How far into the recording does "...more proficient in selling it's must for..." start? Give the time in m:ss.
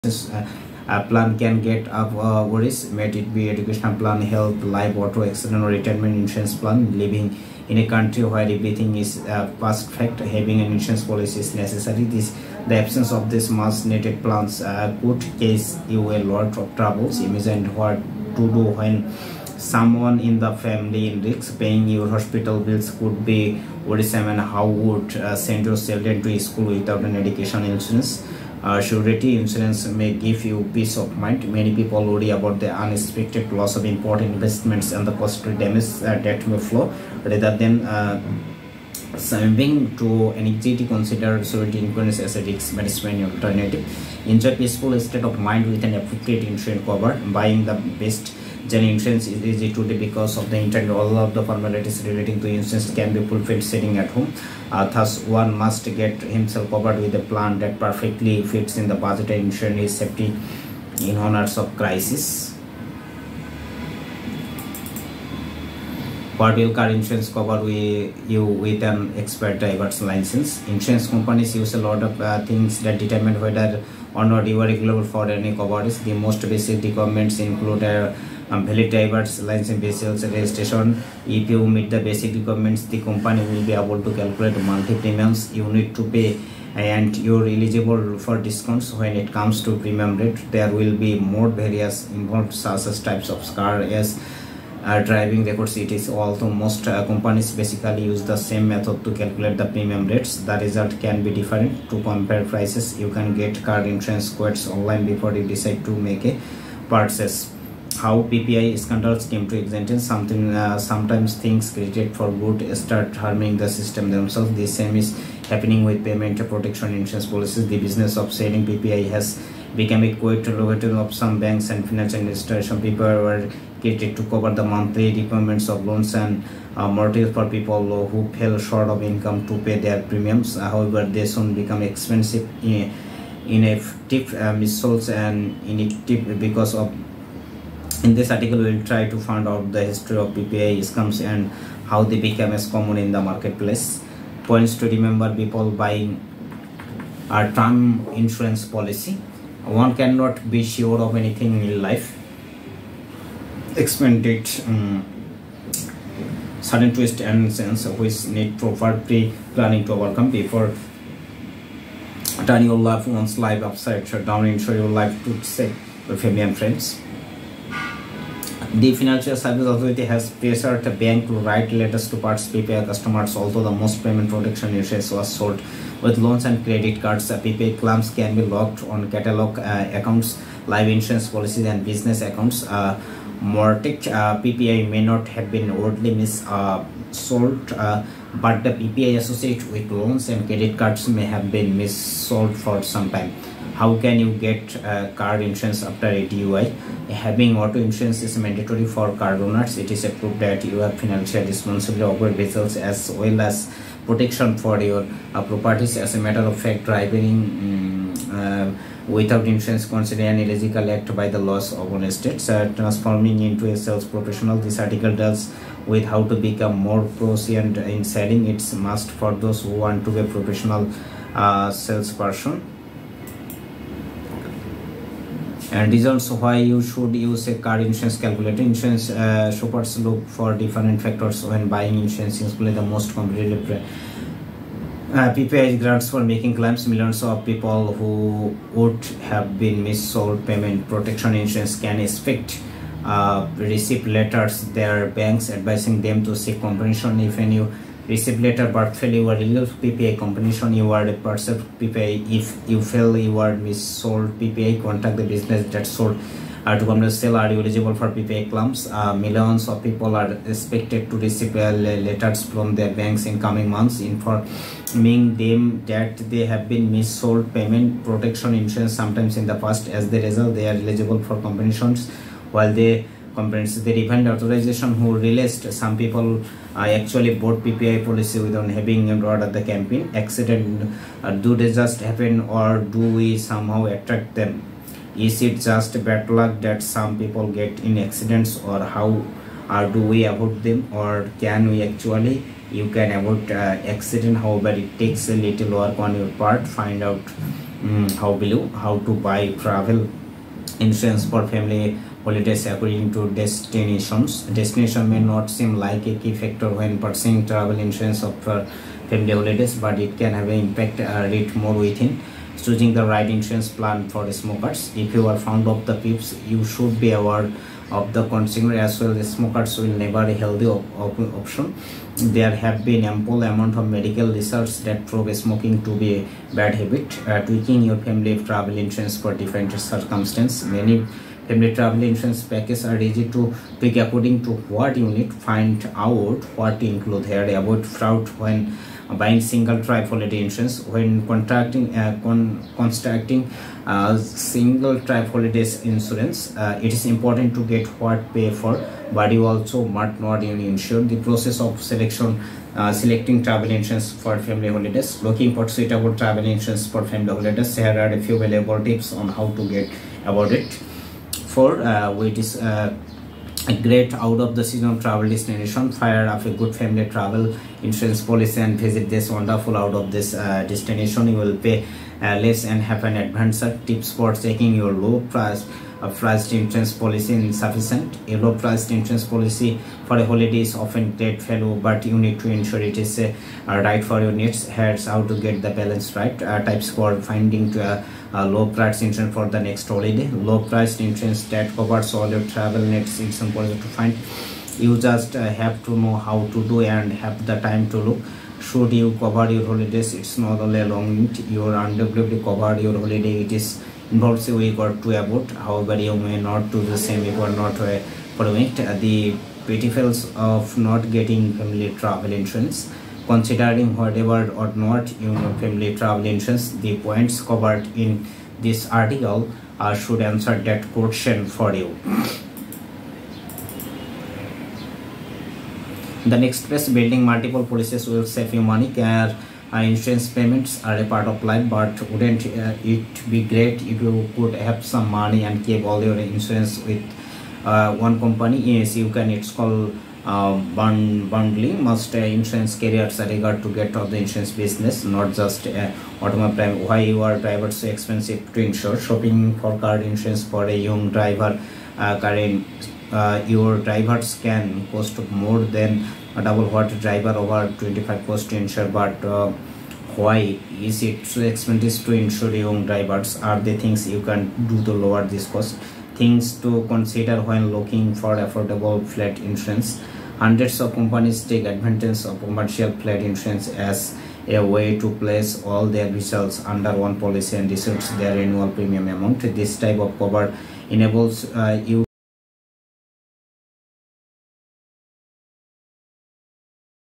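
3:36.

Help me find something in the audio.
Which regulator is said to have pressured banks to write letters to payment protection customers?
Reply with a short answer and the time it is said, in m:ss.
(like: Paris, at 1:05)
Financial Service Authority, at 2:48.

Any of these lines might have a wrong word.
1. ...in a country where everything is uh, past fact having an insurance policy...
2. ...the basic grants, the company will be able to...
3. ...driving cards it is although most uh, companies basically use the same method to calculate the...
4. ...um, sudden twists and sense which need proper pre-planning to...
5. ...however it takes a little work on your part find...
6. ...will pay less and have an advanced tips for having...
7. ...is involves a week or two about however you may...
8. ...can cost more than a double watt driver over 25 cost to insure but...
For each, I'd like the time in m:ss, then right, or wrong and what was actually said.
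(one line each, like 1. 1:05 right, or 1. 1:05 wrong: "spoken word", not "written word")
1. 0:07 right
2. 1:21 wrong: "requirements", not "grants"
3. 1:35 wrong: "records", not "cards"
4. 2:34 right
5. 4:54 right
6. 6:11 wrong: "checking", not "having"
7. 6:43 right
8. 7:34 right.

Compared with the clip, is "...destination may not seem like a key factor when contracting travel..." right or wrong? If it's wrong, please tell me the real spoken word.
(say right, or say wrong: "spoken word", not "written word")
wrong: "purchasing", not "contracting".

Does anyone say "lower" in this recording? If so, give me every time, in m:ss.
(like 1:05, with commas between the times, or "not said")
7:44.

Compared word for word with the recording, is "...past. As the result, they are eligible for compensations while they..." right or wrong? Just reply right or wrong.
right.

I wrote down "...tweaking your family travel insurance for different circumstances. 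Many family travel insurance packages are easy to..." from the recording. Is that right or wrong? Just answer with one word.
right.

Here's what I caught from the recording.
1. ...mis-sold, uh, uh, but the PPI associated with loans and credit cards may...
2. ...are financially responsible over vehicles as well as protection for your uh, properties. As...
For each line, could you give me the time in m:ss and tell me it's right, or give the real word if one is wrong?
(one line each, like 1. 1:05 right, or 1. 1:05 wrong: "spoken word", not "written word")
1. 3:06 right
2. 3:20 right.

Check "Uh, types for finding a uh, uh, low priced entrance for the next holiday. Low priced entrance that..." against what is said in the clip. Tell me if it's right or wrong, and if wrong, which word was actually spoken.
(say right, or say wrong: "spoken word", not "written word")
right.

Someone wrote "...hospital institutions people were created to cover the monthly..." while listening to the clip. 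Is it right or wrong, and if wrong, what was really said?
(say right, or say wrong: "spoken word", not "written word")
wrong: "financial", not "hospital".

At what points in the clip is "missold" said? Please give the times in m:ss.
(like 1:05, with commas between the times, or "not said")
2:14, 3:59, 4:14, 4:26.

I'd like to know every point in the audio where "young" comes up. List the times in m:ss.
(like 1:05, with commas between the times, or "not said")
7:30, 7:42.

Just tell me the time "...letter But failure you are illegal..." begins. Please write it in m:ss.
4:08.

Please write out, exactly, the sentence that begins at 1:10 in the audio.
Insurance companies use a lot of uh, things that determine whether or not you are eligible for any coverage.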